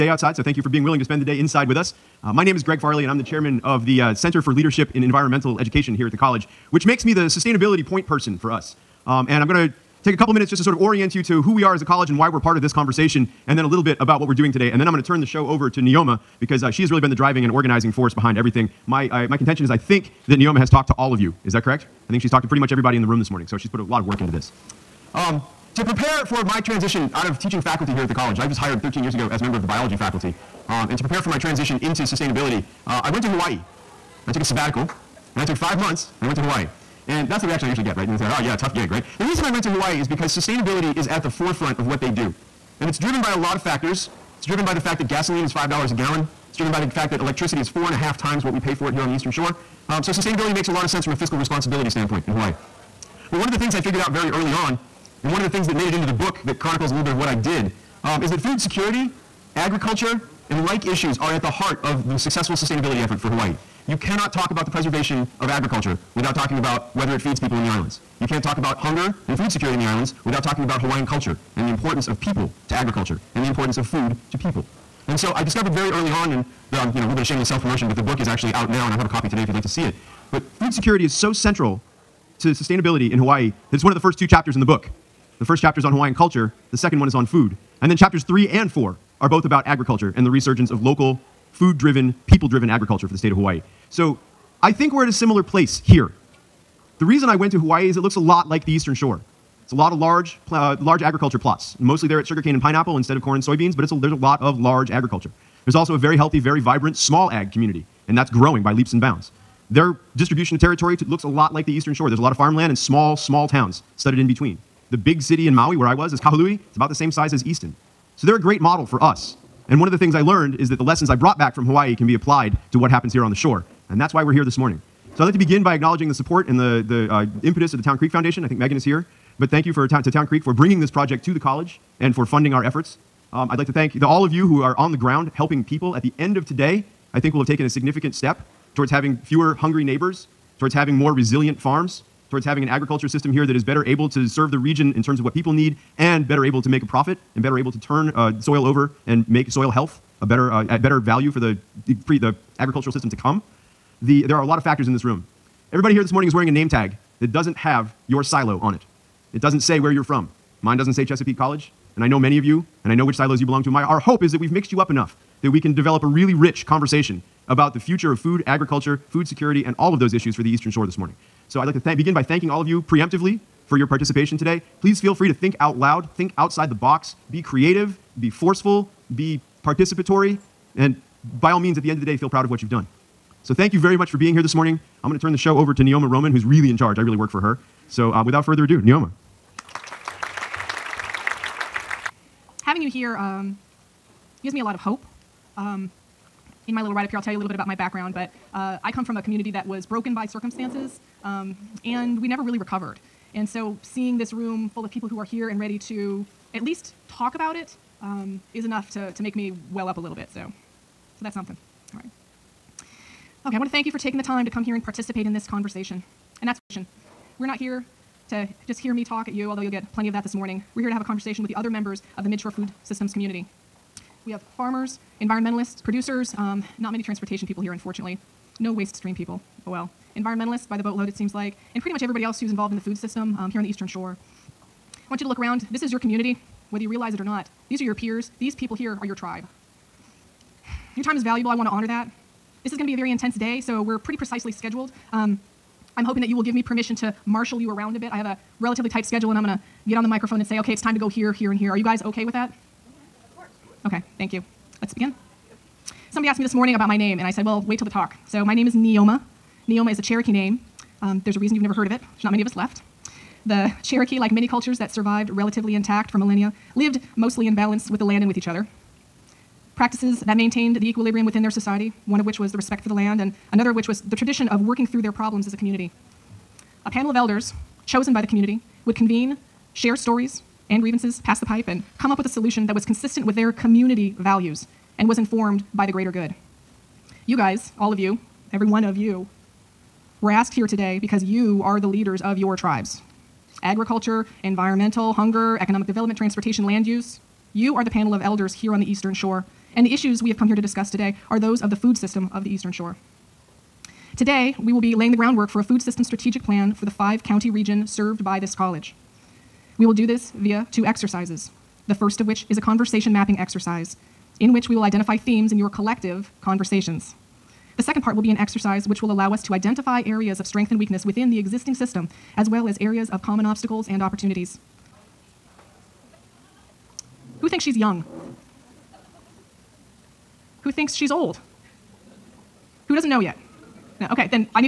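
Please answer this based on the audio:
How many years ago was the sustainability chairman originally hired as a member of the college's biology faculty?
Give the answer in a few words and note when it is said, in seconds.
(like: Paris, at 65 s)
13, at 28 s.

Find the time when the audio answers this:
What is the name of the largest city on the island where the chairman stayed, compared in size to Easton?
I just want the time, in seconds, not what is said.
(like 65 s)
116 s.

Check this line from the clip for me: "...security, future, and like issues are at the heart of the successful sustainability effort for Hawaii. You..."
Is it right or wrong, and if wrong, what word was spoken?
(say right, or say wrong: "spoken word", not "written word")
wrong: "agriculture", not "future".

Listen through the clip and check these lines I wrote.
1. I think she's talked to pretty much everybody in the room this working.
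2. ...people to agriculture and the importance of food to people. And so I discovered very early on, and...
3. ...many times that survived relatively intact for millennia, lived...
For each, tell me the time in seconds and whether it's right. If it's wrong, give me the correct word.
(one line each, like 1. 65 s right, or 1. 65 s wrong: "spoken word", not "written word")
1. 22 s wrong: "morning", not "working"
2. 72 s right
3. 264 s wrong: "cultures", not "times".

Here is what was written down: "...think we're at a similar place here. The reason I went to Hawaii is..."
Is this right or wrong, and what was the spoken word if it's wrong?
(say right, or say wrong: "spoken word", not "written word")
right.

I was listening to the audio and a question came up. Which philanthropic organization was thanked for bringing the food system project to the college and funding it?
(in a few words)
Town Creek Foundation.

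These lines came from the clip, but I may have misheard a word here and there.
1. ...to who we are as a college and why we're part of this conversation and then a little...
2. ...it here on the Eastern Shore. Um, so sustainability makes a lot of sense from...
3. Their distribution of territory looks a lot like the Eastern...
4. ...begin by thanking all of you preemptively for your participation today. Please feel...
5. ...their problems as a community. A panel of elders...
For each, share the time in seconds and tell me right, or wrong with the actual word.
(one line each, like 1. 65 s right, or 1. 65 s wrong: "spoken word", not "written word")
1. 11 s right
2. 48 s right
3. 109 s right
4. 171 s right
5. 275 s right.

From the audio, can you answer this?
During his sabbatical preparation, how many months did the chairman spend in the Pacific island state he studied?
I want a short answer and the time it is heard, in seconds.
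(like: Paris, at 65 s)
5, at 35 s.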